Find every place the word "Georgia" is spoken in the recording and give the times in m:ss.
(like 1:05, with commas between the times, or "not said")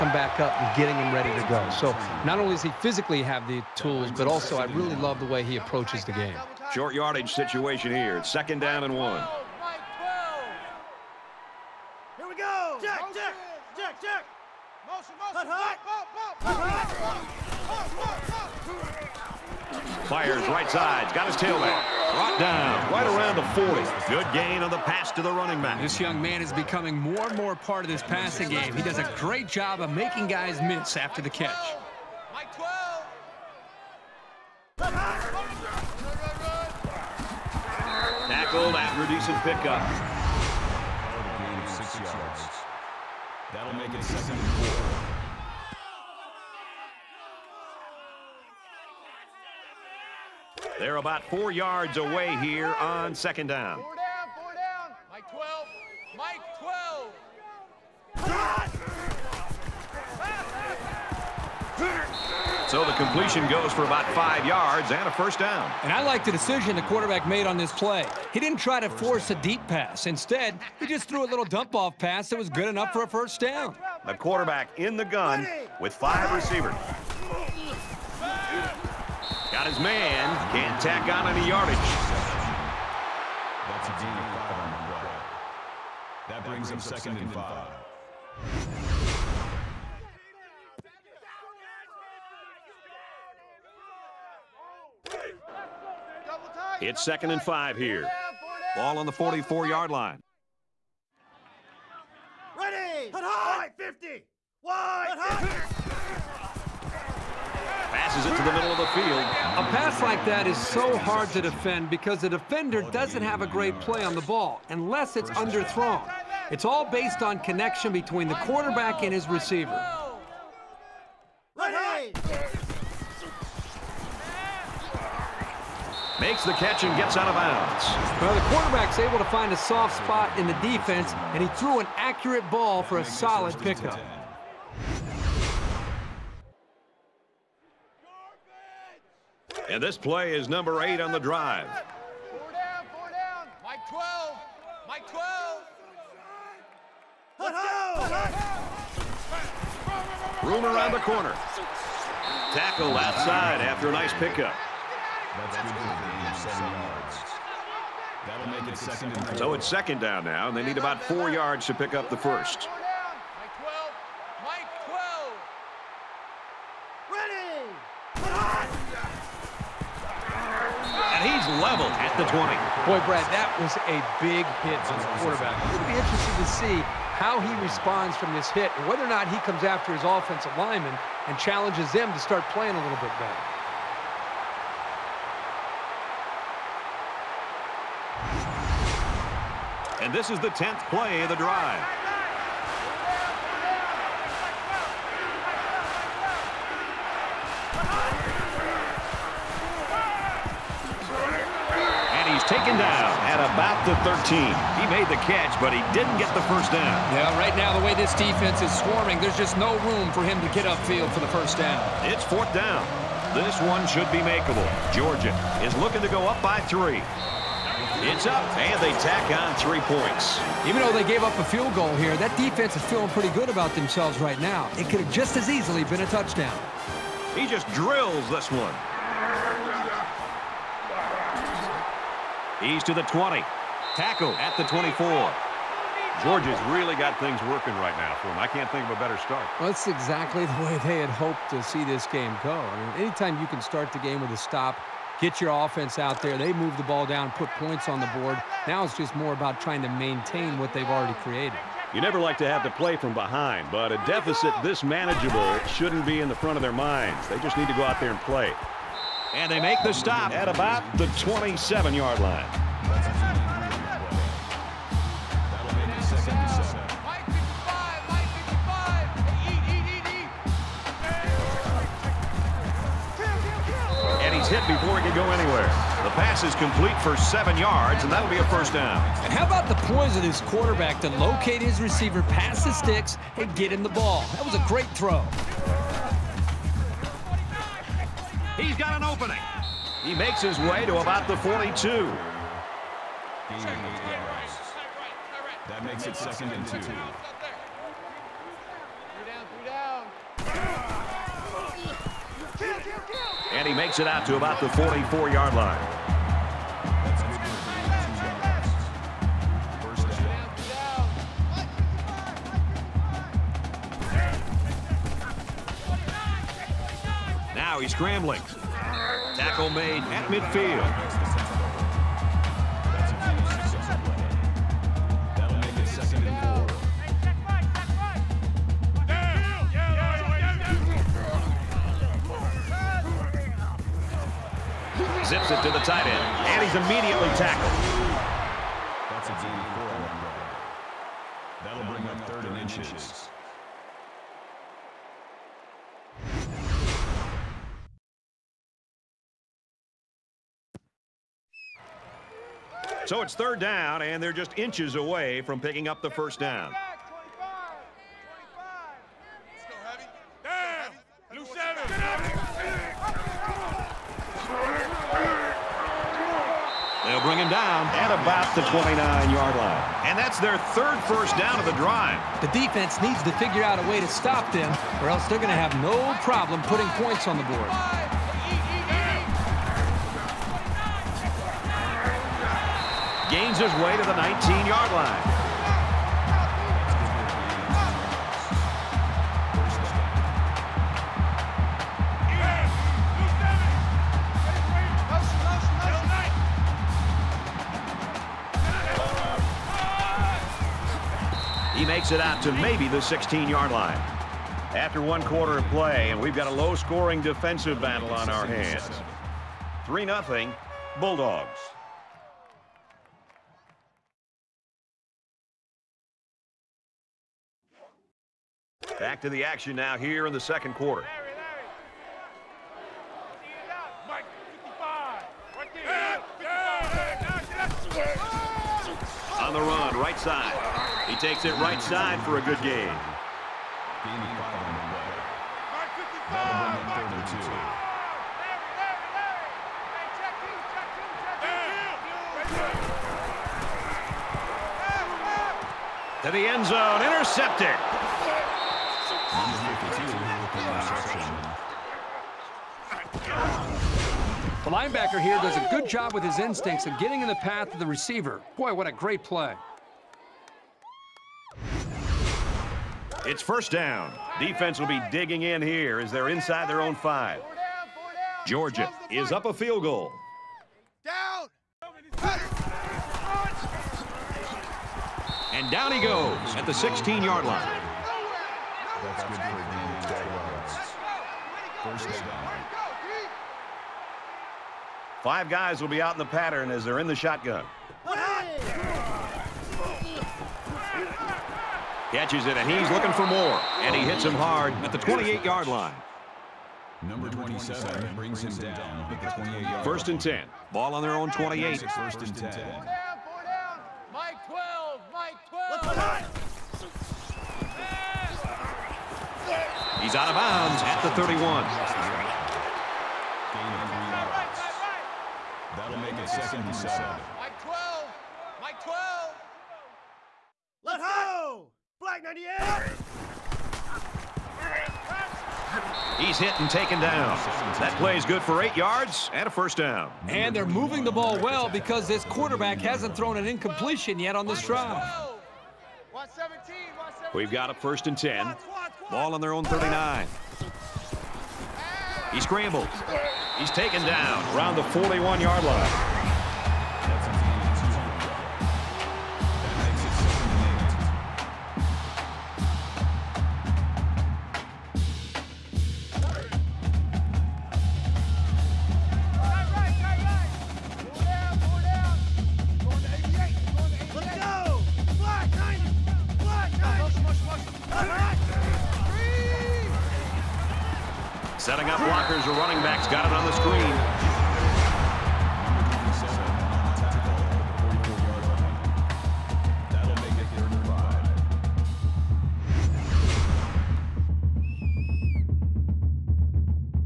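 3:34, 3:56, 7:48.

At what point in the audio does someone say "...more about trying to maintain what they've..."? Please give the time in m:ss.
4:09.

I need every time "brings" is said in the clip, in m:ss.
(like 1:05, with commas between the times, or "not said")
1:26, 5:41, 8:18.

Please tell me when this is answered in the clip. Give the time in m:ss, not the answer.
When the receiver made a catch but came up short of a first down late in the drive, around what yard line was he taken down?
3:23.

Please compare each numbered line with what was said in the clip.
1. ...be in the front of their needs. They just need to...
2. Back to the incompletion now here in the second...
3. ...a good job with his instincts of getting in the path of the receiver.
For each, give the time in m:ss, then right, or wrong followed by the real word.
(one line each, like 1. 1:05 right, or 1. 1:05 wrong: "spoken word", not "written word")
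1. 4:16 wrong: "minds", not "needs"
2. 6:58 wrong: "action", not "incompletion"
3. 7:35 right.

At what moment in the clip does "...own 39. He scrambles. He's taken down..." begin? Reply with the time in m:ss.
8:59.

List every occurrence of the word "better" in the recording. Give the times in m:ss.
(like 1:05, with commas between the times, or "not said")
3:03, 3:58.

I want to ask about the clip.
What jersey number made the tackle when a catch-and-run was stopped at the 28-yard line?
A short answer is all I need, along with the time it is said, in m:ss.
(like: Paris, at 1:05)
27, at 8:17.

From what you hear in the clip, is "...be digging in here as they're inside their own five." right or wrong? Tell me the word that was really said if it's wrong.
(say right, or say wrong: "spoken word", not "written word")
right.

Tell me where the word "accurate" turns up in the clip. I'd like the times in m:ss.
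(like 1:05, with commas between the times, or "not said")
2:11.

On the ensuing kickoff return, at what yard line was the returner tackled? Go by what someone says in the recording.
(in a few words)
24.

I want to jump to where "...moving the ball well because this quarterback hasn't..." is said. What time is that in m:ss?
8:50.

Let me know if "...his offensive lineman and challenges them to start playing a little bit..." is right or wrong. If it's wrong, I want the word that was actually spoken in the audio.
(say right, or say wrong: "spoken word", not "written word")
right.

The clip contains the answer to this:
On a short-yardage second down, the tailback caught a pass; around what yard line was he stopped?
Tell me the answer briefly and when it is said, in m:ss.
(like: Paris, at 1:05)
40, at 0:23.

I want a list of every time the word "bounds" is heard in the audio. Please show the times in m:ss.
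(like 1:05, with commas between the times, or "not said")
2:07, 8:30.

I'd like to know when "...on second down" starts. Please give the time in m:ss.
0:52.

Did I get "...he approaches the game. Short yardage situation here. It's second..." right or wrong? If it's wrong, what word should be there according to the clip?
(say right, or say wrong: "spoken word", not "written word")
right.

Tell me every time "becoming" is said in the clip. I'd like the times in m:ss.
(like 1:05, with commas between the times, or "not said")
0:26.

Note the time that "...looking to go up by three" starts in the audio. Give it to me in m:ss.
3:35.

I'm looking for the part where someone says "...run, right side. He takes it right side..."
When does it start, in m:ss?
7:09.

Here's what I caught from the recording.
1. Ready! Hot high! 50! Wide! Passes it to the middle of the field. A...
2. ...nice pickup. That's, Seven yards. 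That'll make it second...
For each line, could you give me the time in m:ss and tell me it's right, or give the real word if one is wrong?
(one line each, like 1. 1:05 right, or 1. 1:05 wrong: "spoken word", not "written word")
1. 1:42 right
2. 2:33 right.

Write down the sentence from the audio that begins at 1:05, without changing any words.
And I like the decision the quarterback made on this play.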